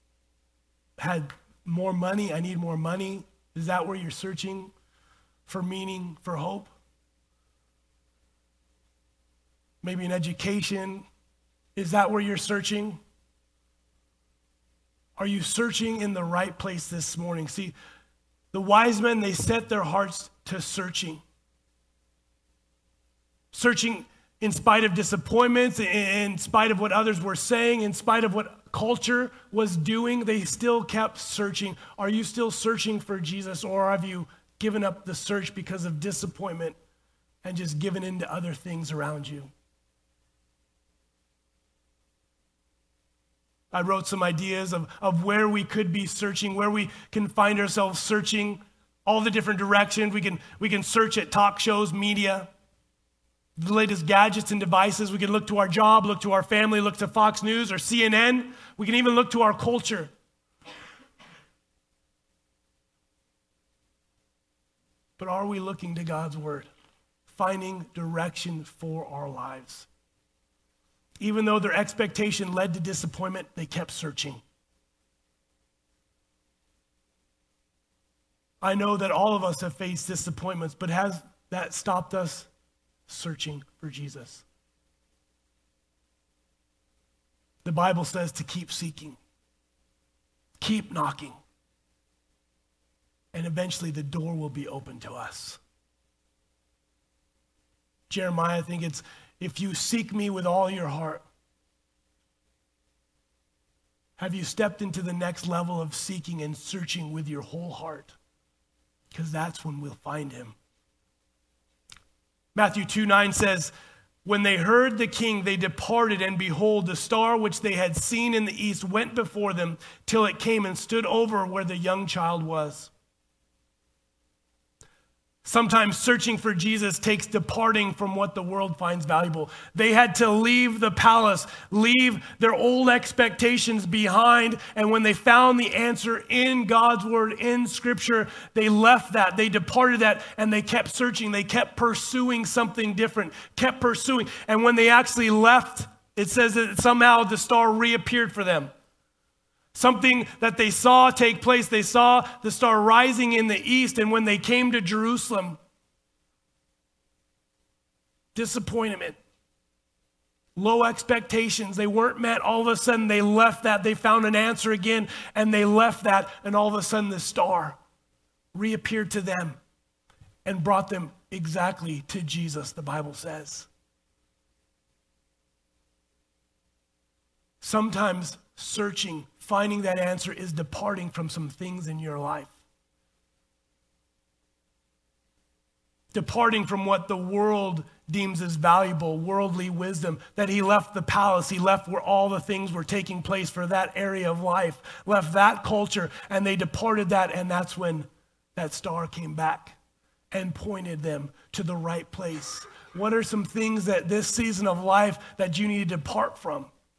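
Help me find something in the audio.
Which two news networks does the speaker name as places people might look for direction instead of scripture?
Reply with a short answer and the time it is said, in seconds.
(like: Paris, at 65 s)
Fox News or CNN, at 57 s.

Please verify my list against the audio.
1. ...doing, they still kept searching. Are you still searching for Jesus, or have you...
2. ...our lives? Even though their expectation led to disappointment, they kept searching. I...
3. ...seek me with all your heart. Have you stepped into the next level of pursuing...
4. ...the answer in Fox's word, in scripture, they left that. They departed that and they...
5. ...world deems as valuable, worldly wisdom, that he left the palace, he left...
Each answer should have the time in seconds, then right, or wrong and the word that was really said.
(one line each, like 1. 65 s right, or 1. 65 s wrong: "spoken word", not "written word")
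1. 29 s right
2. 69 s right
3. 99 s wrong: "seeking", not "pursuing"
4. 135 s wrong: "God", not "Fox"
5. 187 s right.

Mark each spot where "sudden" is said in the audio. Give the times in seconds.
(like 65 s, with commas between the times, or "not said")
162 s, 166 s.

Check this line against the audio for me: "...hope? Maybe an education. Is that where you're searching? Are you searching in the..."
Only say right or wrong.
right.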